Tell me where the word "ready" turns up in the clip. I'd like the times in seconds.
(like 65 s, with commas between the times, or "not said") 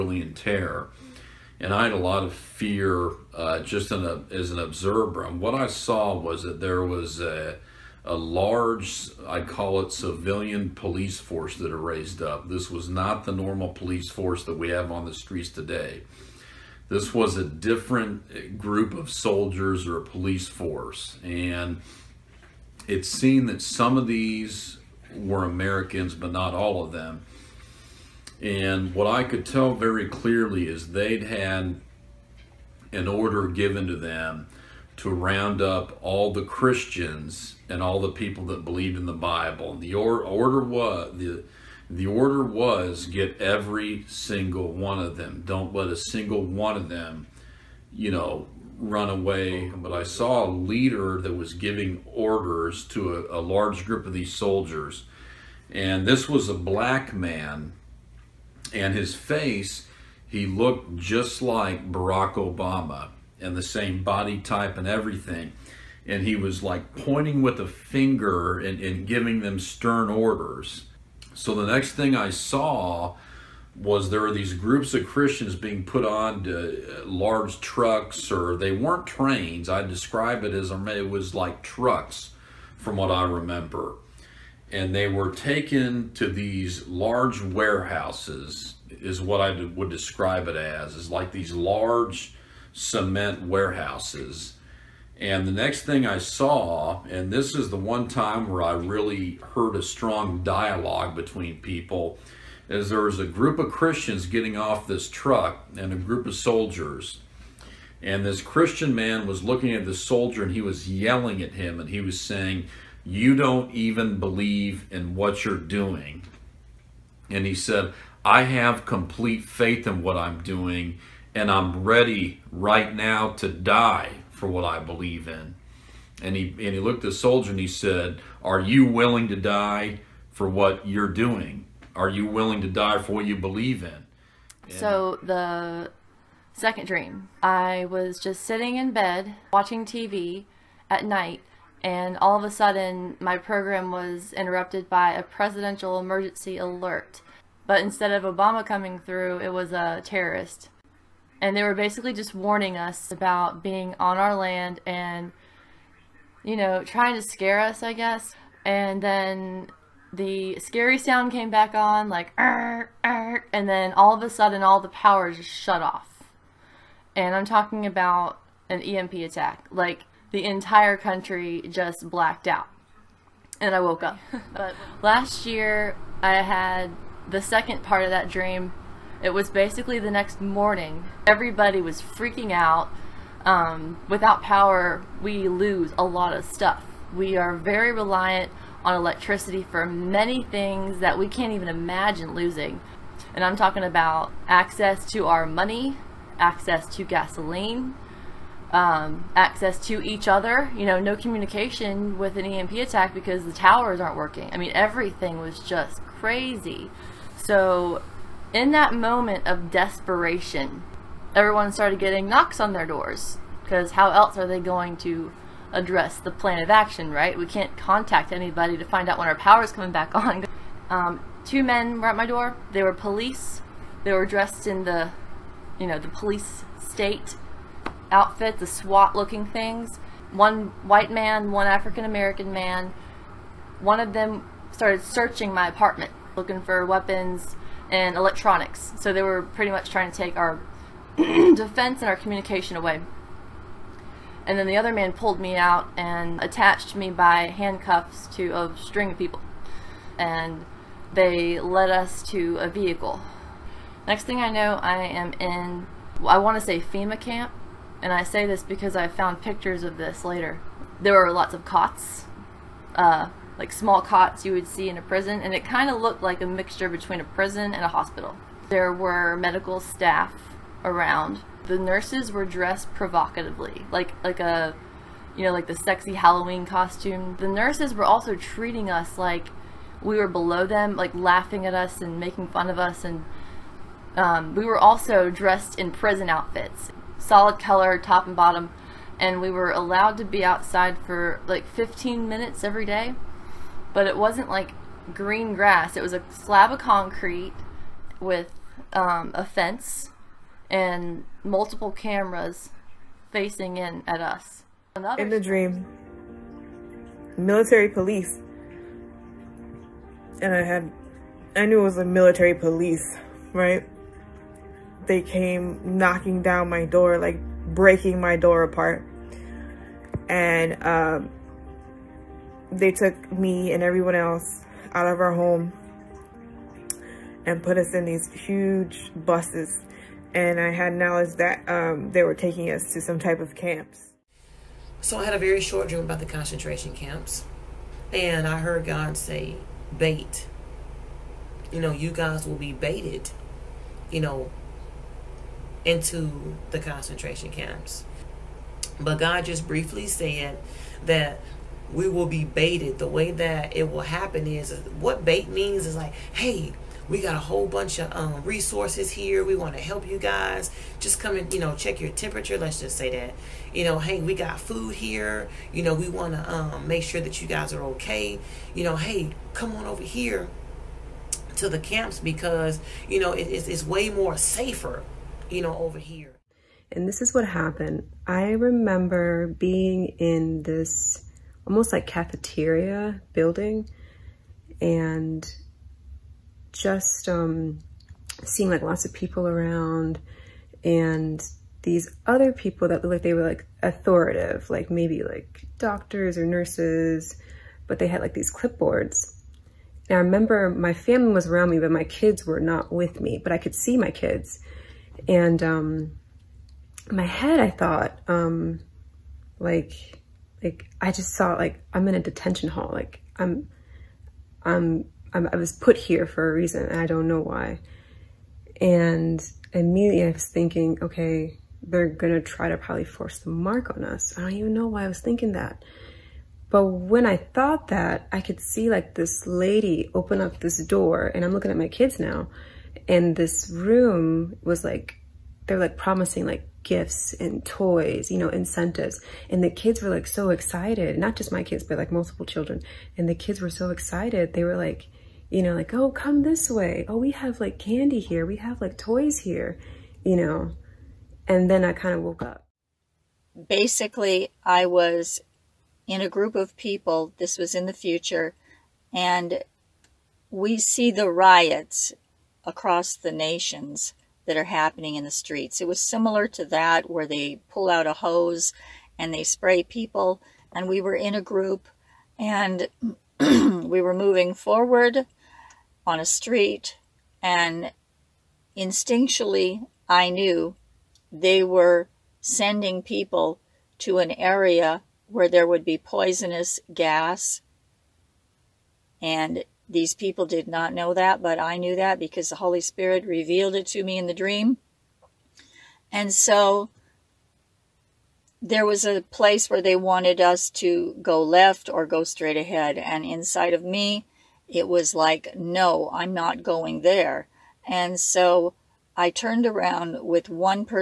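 121 s.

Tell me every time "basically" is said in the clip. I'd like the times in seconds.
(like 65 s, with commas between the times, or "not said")
151 s, 179 s, 453 s.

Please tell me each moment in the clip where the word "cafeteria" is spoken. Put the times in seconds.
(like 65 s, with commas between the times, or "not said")
382 s.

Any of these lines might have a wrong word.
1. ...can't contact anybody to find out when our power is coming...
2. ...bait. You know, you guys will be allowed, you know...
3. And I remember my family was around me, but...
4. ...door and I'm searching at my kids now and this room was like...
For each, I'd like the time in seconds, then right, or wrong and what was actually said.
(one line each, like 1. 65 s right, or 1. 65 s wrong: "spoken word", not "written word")
1. 217 s right
2. 339 s wrong: "baited", not "allowed"
3. 400 s right
4. 430 s wrong: "looking", not "searching".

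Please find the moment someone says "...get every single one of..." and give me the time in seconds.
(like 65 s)
43 s.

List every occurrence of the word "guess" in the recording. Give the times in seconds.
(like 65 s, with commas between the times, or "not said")
157 s.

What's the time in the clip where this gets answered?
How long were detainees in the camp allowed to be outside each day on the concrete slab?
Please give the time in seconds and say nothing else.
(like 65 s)
291 s.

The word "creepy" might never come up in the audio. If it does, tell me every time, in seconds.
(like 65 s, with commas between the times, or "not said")
not said.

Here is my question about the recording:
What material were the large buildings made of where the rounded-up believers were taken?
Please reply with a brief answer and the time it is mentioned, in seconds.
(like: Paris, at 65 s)
Cement, at 92 s.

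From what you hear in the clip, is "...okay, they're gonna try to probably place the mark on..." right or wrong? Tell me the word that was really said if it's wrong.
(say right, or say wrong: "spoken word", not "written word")
wrong: "force", not "place".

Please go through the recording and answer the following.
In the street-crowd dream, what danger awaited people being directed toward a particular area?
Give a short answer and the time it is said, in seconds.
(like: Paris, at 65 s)
Poisonous gas, at 485 s.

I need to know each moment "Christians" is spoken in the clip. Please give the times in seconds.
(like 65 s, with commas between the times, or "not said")
36 s, 75 s, 103 s, 108 s.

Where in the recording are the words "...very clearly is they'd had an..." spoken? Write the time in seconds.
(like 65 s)
29 s.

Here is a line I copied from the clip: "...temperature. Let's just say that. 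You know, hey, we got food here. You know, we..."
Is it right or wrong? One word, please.
right.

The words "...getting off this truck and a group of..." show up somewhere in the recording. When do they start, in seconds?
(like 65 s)
104 s.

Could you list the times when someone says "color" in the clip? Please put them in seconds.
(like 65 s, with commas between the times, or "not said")
287 s.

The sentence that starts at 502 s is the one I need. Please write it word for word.
And inside of me, it was like, no, I'm not going there.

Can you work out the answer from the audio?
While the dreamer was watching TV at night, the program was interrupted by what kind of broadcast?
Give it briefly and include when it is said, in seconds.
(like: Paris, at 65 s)
Presidential emergency alert, at 145 s.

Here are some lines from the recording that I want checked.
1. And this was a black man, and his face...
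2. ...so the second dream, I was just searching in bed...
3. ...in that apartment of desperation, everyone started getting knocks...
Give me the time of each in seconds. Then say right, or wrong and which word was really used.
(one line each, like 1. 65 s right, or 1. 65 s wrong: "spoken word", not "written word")
1. 55 s right
2. 134 s wrong: "sitting", not "searching"
3. 208 s wrong: "moment", not "apartment".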